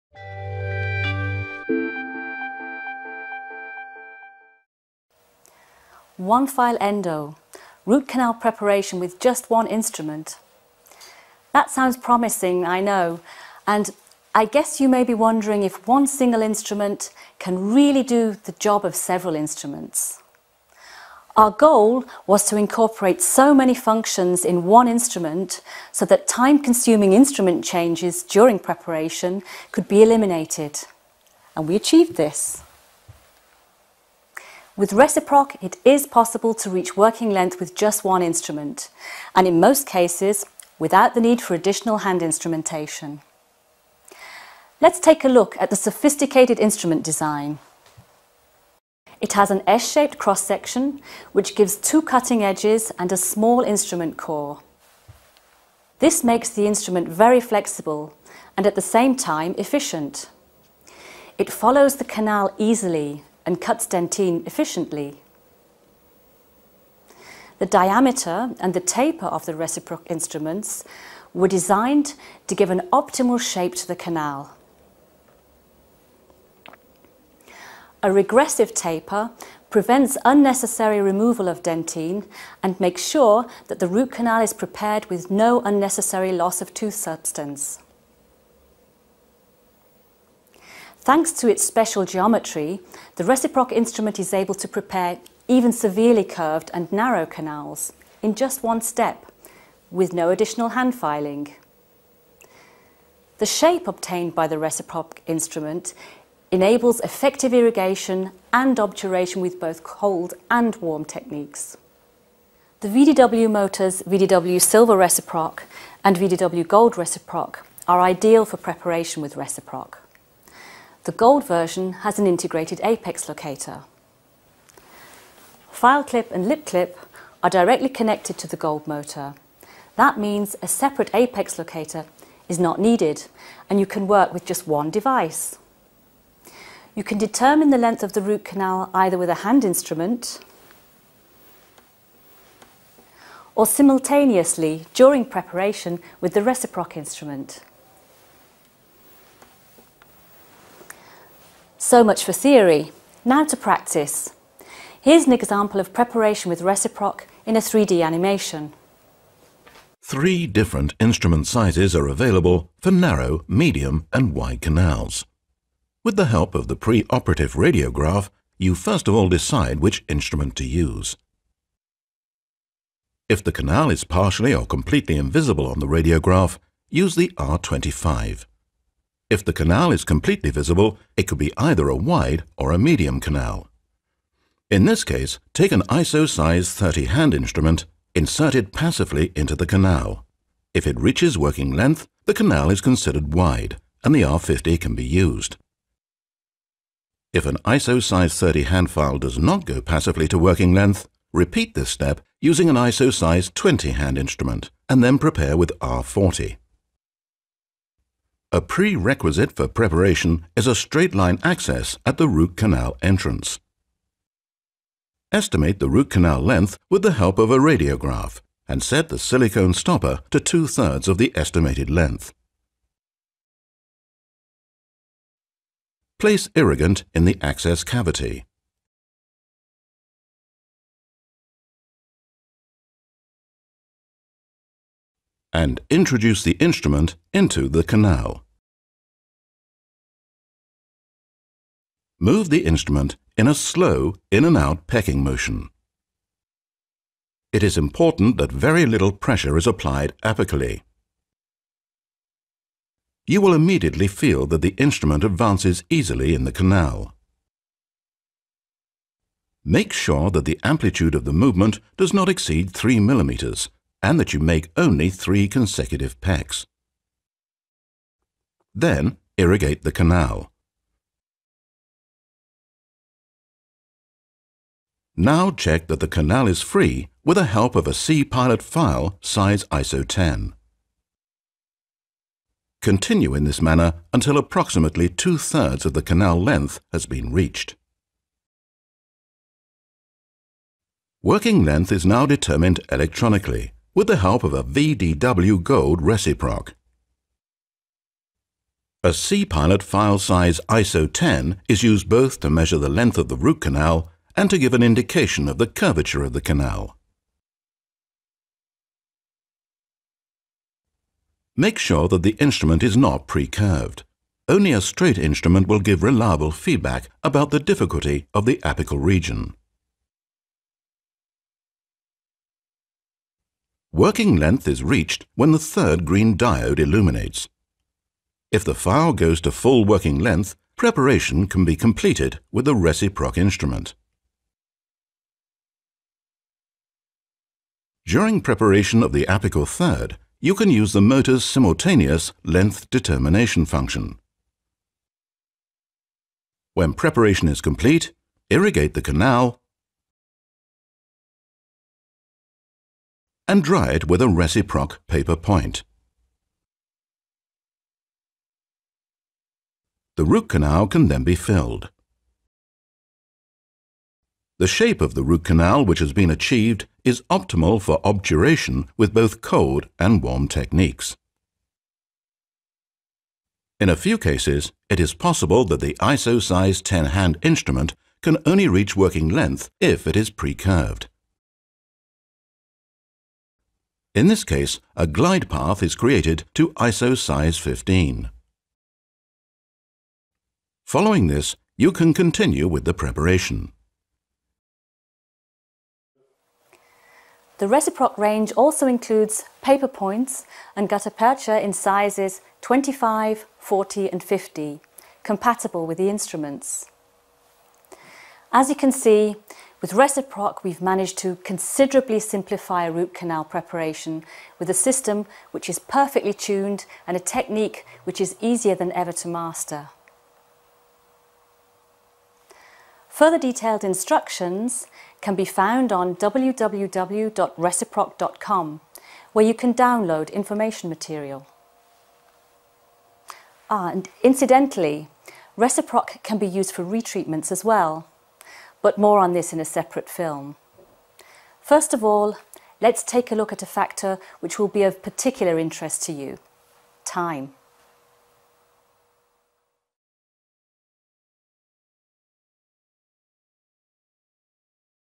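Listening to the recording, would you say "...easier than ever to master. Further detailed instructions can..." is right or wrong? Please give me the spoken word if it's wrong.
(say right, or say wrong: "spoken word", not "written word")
right.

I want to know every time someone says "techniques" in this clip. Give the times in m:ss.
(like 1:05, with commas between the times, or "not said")
1:51, 6:10, 6:57.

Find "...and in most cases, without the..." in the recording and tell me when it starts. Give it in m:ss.
0:39.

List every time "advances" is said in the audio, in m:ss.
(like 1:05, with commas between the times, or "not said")
4:15.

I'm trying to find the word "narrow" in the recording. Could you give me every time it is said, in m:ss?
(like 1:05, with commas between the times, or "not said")
1:36, 2:42.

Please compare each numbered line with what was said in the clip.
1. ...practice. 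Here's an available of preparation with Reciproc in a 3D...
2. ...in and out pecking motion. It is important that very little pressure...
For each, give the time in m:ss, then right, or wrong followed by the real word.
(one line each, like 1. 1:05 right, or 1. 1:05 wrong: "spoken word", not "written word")
1. 2:33 wrong: "example", not "available"
2. 4:04 right.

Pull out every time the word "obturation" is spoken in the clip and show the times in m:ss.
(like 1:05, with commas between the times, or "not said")
1:48, 6:08.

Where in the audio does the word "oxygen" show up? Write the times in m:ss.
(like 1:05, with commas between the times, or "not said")
not said.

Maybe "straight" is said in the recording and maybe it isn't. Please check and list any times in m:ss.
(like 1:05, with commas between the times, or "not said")
3:30, 5:14.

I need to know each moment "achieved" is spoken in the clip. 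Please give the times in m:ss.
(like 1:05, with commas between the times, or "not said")
0:31, 6:06.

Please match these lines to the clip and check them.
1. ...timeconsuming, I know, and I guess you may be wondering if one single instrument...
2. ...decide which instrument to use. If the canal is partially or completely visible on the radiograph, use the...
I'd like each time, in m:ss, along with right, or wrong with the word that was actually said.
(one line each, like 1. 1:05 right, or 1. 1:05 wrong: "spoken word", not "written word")
1. 0:11 wrong: "promising", not "timeconsuming"
2. 2:49 wrong: "invisible", not "visible".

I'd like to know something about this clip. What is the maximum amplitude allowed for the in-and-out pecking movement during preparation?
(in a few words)
3 millimeters.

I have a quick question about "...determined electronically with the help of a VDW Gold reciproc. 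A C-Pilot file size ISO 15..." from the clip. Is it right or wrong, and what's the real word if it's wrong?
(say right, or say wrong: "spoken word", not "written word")
wrong: "10", not "15".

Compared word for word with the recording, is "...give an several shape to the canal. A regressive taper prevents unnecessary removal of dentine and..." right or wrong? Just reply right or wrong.
wrong.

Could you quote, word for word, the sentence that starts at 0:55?
This makes the instrument very flexible and at the same time efficient.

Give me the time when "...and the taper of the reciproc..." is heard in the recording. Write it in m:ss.
1:08.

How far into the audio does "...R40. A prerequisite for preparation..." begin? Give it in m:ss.
3:25.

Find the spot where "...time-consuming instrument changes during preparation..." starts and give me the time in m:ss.
0:26.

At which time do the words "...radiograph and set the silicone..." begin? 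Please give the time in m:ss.
3:37.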